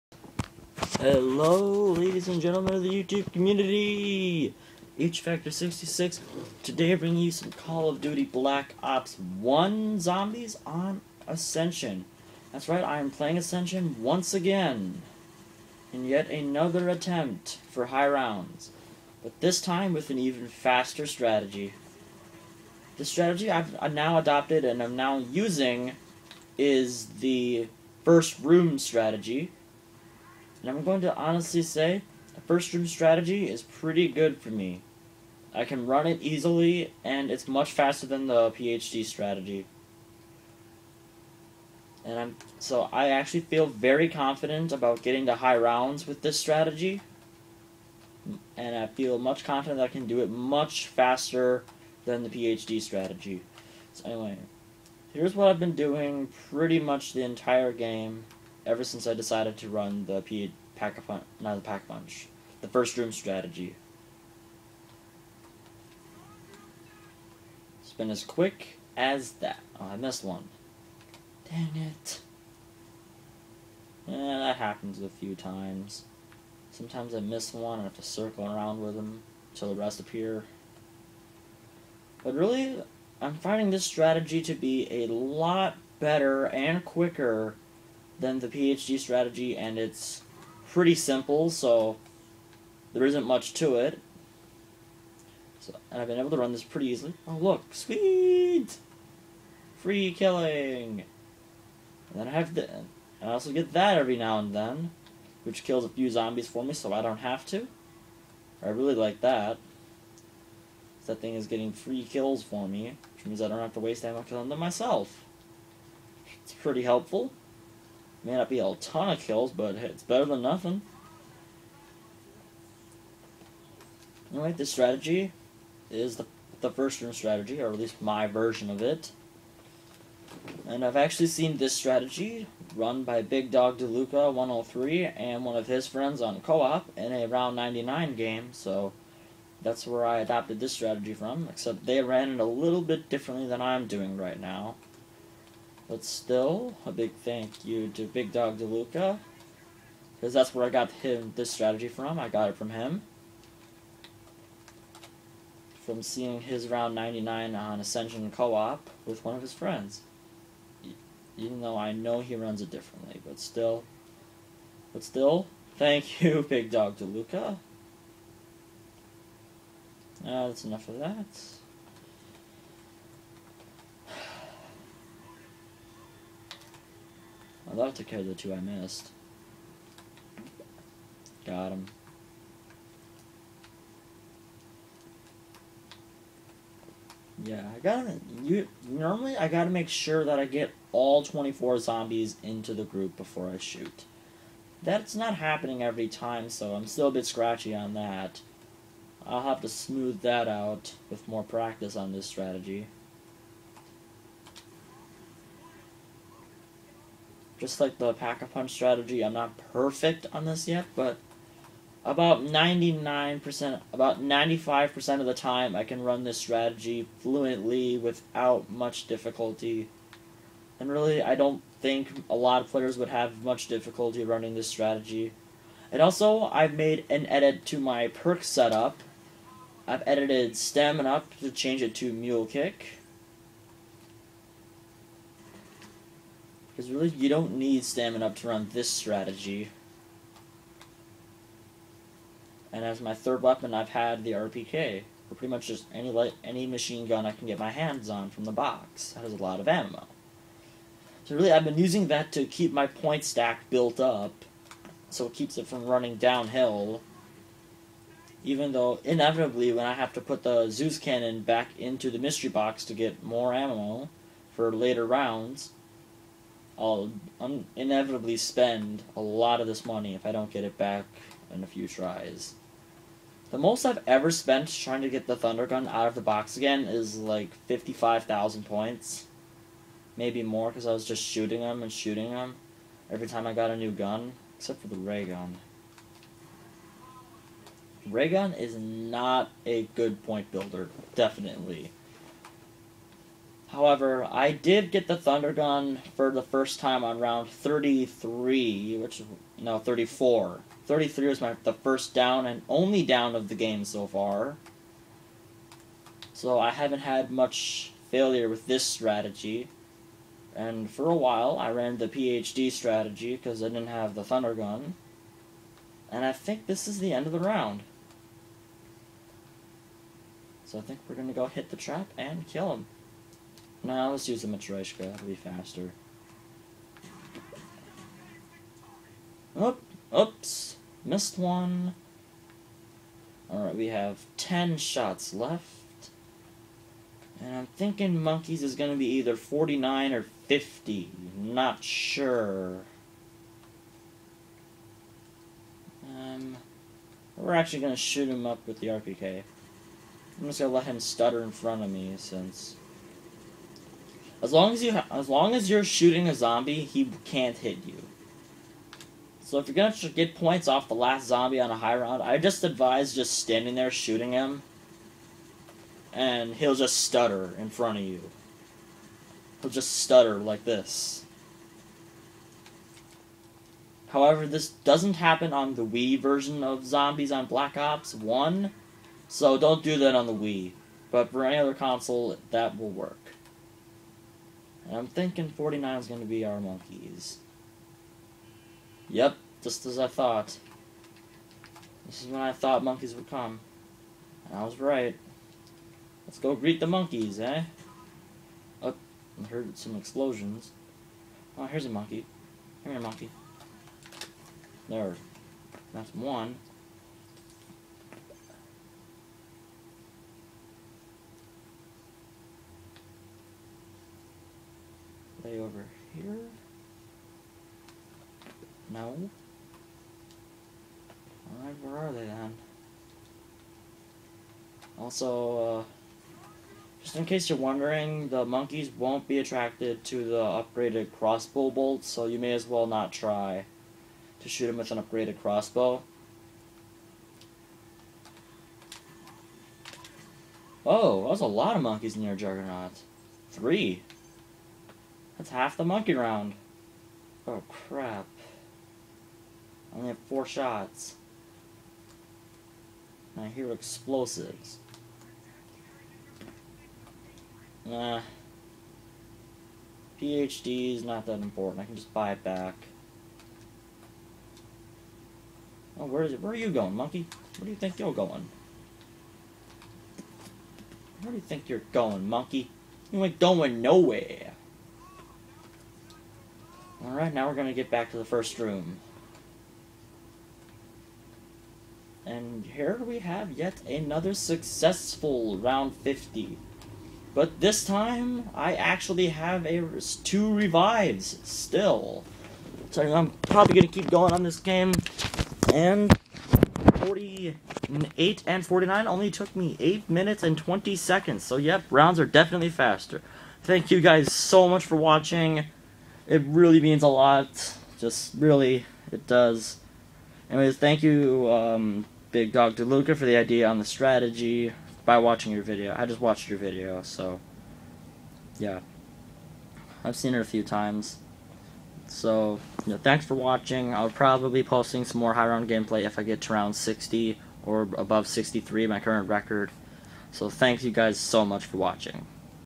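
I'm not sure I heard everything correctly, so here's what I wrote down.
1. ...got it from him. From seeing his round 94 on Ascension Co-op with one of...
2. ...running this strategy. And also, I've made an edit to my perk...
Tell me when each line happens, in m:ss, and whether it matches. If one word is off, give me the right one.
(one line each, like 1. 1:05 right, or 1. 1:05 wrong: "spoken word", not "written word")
1. 2:32 wrong: "99", not "94"
2. 3:44 right.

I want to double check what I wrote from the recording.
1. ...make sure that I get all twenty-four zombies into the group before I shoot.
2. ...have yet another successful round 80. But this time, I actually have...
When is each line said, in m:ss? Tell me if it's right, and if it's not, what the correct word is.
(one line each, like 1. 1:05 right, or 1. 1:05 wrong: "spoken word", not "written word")
1. 3:09 right
2. 8:03 wrong: "50", not "80".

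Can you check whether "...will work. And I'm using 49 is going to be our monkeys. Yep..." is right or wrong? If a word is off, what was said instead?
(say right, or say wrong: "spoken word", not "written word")
wrong: "thinking", not "using".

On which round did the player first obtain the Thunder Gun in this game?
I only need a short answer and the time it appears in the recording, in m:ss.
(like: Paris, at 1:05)
34, at 4:59.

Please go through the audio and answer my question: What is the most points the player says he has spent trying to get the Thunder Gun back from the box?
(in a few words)
55,000.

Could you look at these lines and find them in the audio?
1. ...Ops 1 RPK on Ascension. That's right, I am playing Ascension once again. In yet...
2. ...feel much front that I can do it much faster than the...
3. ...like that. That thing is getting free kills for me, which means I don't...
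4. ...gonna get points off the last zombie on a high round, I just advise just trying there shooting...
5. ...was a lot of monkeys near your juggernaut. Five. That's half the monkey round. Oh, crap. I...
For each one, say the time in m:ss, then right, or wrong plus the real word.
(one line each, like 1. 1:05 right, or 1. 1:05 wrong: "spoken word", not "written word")
1. 0:08 wrong: "Zombies", not "RPK"
2. 0:48 wrong: "confident", not "front"
3. 1:48 right
4. 5:59 wrong: "standing", not "trying"
5. 7:21 wrong: "Three", not "Five".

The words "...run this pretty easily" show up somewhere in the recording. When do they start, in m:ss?
1:36.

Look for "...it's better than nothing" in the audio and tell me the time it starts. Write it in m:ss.
1:59.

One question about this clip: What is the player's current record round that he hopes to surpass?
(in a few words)
63.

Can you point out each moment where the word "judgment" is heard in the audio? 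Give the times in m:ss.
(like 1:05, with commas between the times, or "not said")
not said.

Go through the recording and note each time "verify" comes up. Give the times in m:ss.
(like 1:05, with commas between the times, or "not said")
not said.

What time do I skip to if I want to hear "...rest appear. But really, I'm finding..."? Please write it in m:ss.
1:19.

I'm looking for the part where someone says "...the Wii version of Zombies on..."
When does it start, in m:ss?
6:15.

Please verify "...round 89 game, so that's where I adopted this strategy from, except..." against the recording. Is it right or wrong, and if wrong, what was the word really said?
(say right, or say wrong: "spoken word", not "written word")
wrong: "99", not "89".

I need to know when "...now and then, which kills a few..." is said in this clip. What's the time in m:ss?
1:44.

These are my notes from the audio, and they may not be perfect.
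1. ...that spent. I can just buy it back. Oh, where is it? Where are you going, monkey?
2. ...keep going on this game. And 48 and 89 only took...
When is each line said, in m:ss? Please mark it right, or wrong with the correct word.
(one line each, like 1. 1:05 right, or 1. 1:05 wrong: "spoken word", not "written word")
1. 7:41 wrong: "important", not "spent"
2. 8:14 wrong: "49", not "89".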